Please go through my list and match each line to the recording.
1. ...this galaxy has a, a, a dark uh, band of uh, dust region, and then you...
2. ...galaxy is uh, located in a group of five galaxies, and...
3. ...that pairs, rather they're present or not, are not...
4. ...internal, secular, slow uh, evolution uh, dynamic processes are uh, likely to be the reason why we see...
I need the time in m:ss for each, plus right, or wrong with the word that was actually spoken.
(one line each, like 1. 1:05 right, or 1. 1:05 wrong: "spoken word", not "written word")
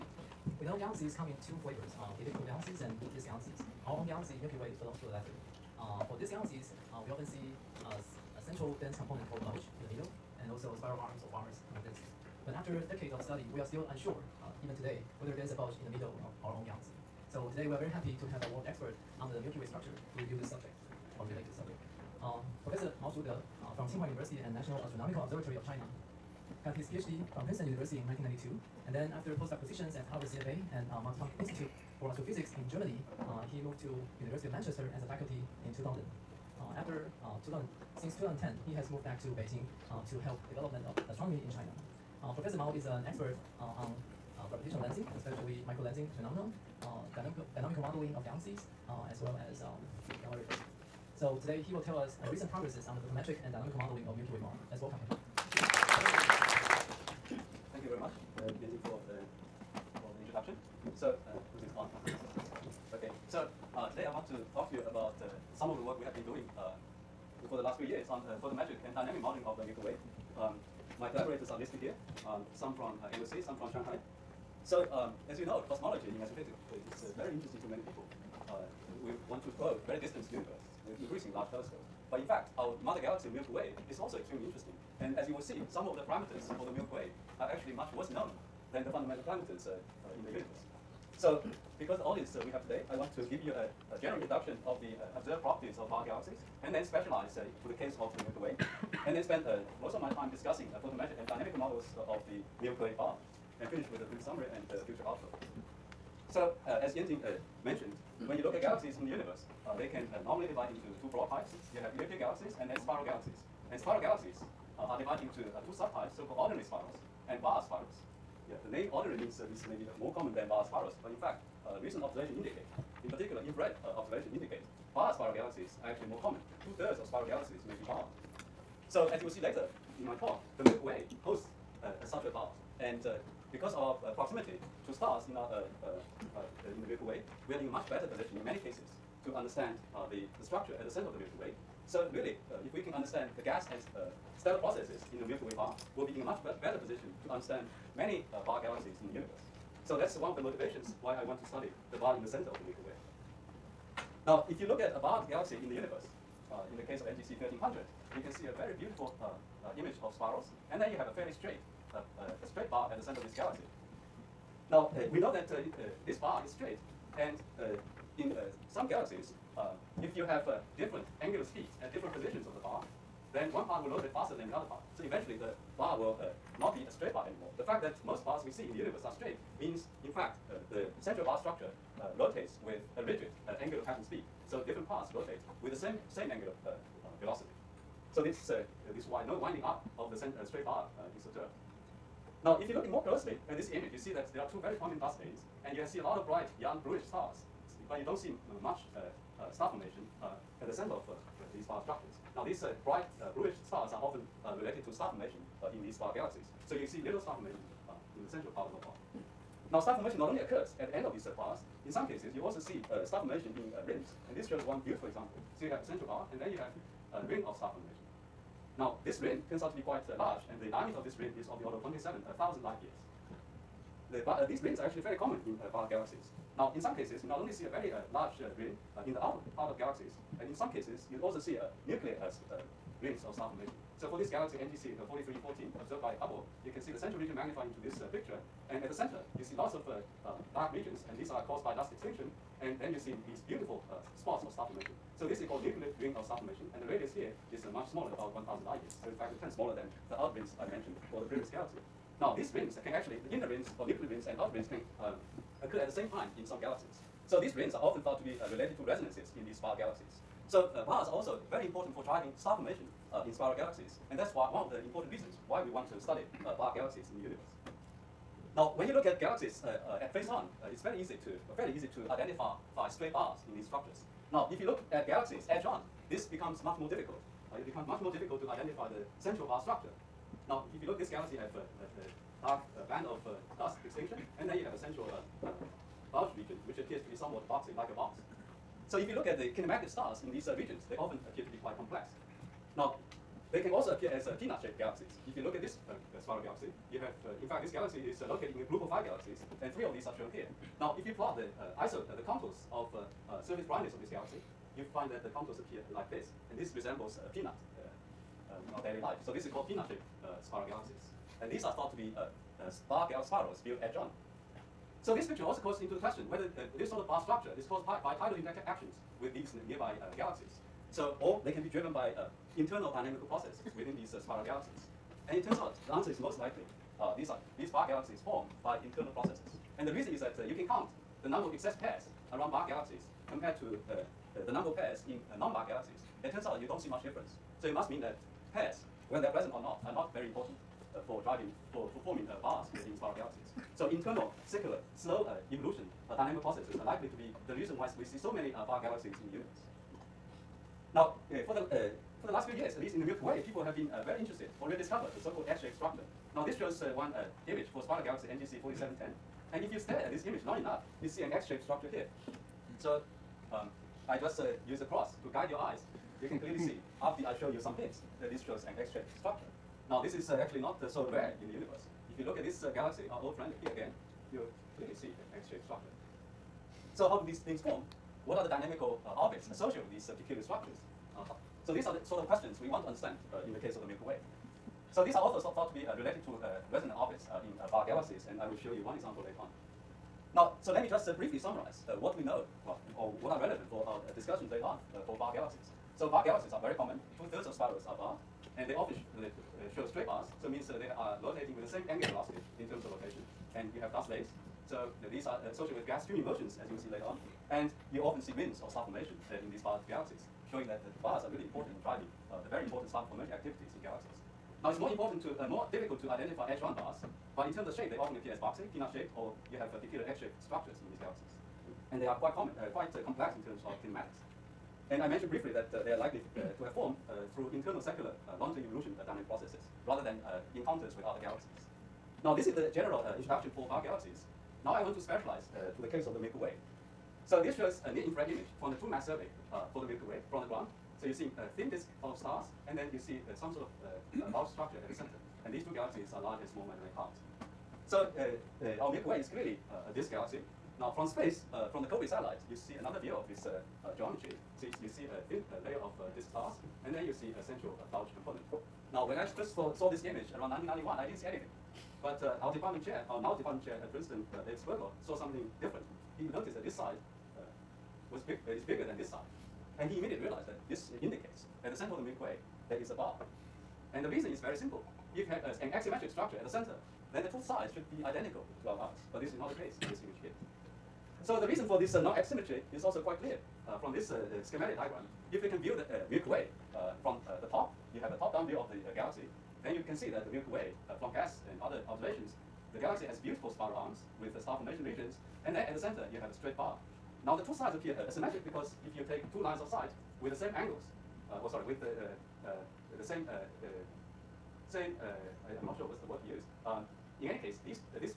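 1. 4:40 wrong: "extinction", not "region"
2. 4:57 right
3. 5:38 wrong: "whether", not "rather"
4. 5:43 right.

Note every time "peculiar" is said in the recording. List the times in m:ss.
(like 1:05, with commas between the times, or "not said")
6:20, 6:59.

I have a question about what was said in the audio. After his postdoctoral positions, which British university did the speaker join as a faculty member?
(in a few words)
University of Manchester.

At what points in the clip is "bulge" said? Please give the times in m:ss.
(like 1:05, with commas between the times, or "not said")
0:09, 0:15, 4:46.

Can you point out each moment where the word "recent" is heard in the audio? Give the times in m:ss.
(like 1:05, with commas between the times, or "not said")
0:52, 2:01.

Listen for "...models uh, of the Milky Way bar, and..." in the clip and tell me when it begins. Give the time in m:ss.
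1:41.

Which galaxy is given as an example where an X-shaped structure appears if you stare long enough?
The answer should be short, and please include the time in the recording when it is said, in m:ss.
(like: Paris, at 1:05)
NGC 4710, at 5:58.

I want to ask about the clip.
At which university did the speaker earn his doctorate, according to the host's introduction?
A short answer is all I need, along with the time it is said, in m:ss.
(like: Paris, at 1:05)
Princeton University, at 0:27.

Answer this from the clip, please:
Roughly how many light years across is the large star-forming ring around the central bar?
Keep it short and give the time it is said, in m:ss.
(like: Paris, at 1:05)
27,000 light years, at 3:41.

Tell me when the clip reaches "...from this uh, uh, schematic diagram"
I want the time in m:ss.
8:03.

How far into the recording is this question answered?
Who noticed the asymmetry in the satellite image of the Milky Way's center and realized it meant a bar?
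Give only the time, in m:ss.
7:44.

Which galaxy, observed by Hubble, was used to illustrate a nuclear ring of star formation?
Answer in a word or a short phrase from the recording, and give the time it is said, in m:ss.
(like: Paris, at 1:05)
NGC 4314, at 3:54.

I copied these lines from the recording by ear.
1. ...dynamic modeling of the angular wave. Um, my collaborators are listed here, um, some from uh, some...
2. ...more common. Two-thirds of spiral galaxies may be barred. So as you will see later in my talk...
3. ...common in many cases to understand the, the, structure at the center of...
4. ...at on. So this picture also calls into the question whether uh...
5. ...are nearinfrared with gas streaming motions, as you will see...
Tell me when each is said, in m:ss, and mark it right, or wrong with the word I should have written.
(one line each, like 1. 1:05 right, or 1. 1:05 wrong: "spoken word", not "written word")
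1. 1:08 wrong: "nuclear", not "angular"
2. 2:06 right
3. 2:18 wrong: "position", not "common"
4. 5:13 right
5. 6:45 wrong: "associated", not "nearinfrared".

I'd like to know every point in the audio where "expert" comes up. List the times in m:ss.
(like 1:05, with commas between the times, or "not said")
0:18, 0:43.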